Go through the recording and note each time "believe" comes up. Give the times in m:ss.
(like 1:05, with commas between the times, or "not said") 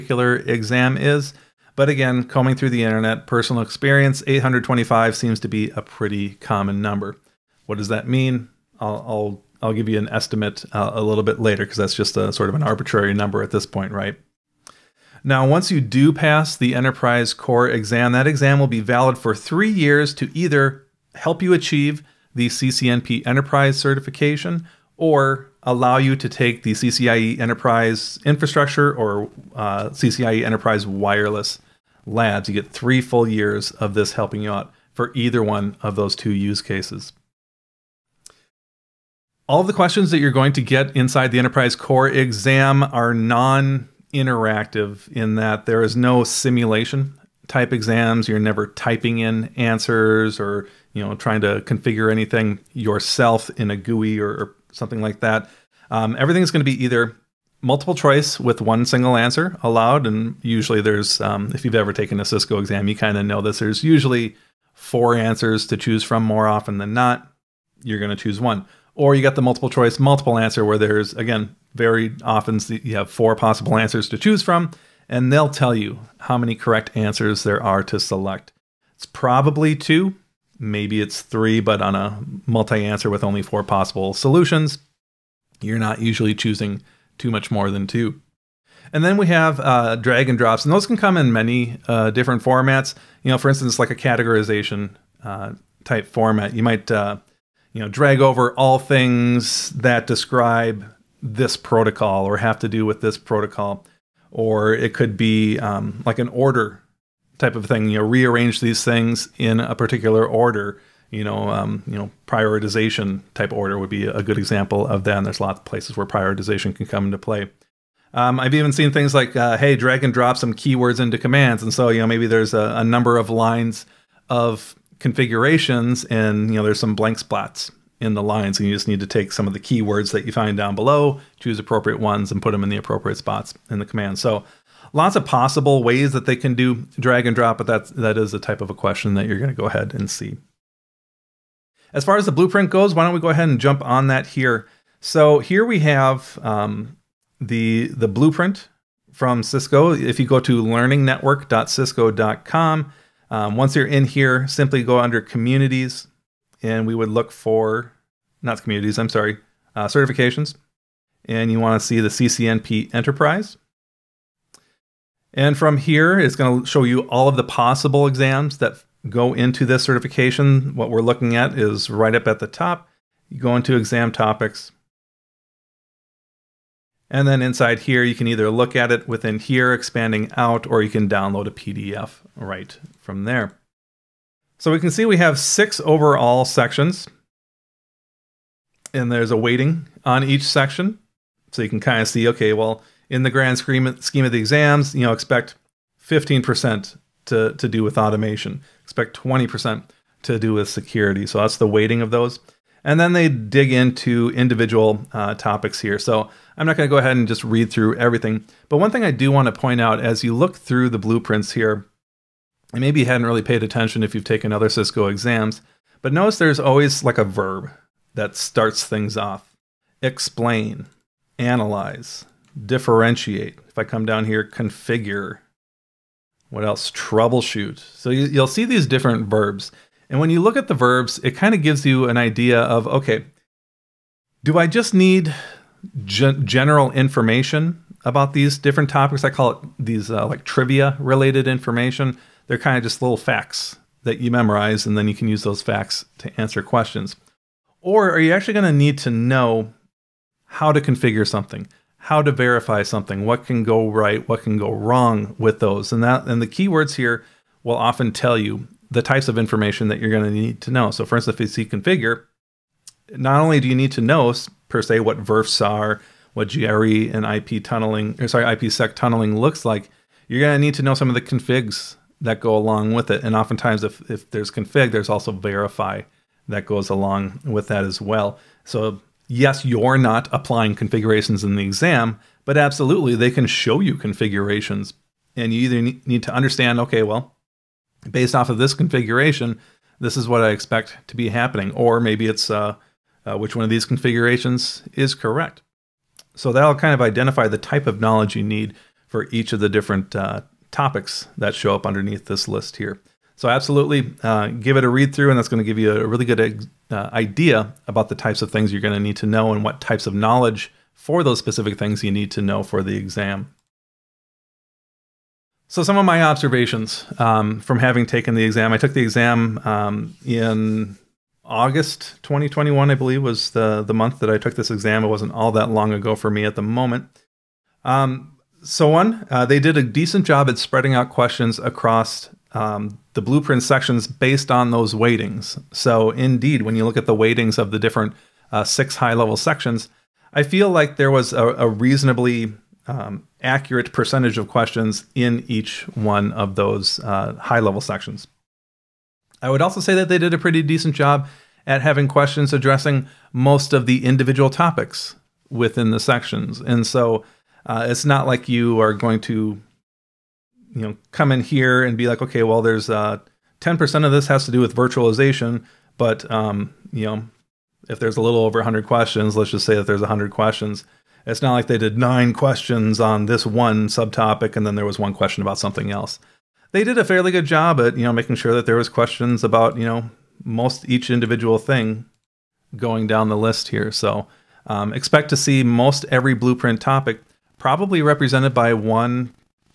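5:22.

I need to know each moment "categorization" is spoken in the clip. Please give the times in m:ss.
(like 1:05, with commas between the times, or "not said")
1:33.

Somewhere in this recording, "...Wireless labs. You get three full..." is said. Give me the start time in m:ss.
0:30.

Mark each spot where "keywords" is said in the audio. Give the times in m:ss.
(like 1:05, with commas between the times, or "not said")
2:00, 2:09, 4:16.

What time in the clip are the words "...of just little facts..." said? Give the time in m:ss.
4:02.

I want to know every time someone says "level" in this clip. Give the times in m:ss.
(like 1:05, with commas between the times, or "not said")
5:39, 5:47.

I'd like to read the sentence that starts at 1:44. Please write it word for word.
Or it could be um, like an order type of thing, you know, rearrange these things in a particular order.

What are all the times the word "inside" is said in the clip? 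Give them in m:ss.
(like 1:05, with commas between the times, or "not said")
0:40, 2:57.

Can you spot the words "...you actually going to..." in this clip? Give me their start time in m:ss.
4:08.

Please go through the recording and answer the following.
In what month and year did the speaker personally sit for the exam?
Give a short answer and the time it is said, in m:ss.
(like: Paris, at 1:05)
August 2021, at 5:21.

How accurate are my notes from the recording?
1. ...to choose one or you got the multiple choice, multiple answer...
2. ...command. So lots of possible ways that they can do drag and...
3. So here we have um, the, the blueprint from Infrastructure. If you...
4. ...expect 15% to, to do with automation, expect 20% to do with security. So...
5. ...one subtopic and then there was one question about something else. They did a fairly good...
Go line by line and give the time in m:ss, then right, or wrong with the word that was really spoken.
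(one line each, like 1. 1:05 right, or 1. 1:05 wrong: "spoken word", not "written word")
1. 1:08 right
2. 2:13 right
3. 2:24 wrong: "Cisco", not "Infrastructure"
4. 3:15 right
5. 6:13 right.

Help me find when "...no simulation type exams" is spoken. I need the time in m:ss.
0:45.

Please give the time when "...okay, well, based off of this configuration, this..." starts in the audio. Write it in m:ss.
4:46.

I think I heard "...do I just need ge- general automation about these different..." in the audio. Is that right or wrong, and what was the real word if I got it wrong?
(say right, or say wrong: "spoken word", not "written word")
wrong: "information", not "automation".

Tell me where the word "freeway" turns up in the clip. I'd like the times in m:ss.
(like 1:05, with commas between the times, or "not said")
not said.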